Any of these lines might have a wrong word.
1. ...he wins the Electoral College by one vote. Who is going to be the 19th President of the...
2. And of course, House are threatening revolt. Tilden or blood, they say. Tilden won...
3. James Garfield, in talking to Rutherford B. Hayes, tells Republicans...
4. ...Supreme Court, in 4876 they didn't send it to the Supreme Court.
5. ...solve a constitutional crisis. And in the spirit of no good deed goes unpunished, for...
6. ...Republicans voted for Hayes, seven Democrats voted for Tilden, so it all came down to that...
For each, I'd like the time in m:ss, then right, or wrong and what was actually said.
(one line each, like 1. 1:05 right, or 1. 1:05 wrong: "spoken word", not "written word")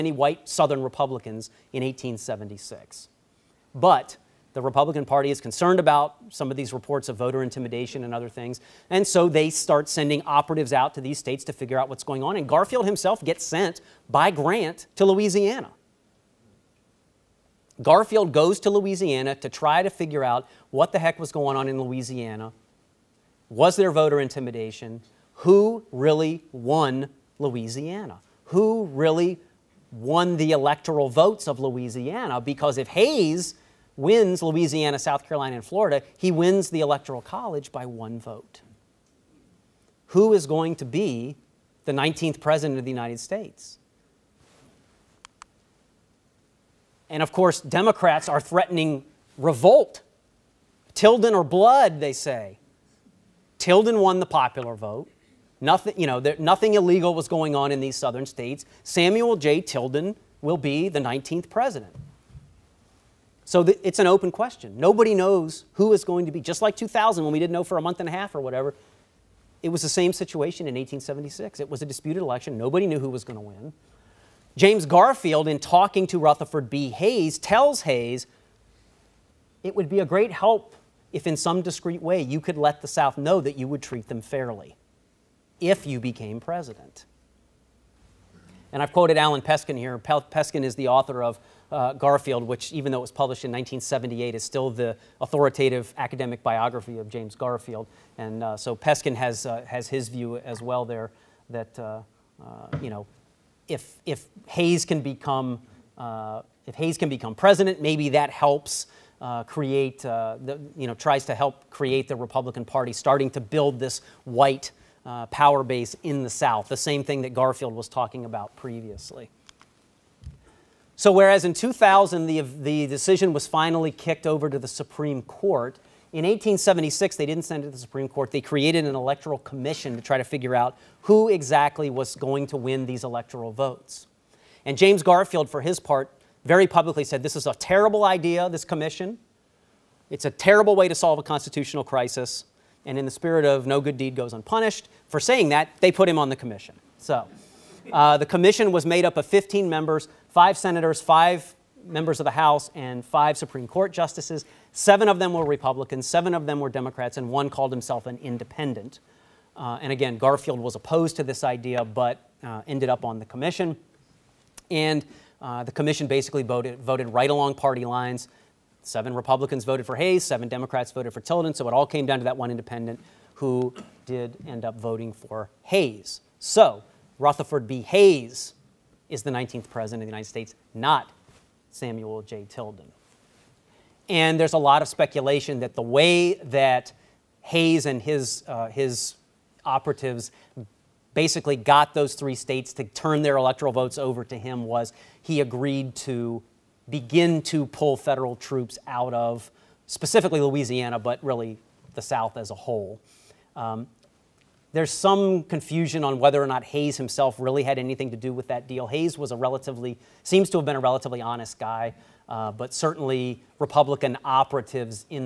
1. 0:36 right
2. 0:47 wrong: "Democrats", not "House"
3. 1:14 wrong: "Hayes", not "Republicans"
4. 2:04 wrong: "1876", not "4876"
5. 2:20 right
6. 2:49 right.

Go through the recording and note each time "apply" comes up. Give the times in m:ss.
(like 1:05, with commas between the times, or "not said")
not said.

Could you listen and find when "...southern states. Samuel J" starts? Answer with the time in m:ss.
0:57.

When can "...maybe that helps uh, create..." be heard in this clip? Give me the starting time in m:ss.
1:47.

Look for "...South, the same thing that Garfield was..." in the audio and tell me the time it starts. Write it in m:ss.
1:56.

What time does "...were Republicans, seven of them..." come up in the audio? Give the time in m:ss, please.
2:35.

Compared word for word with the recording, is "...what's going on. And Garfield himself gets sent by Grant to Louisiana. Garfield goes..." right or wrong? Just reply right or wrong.
right.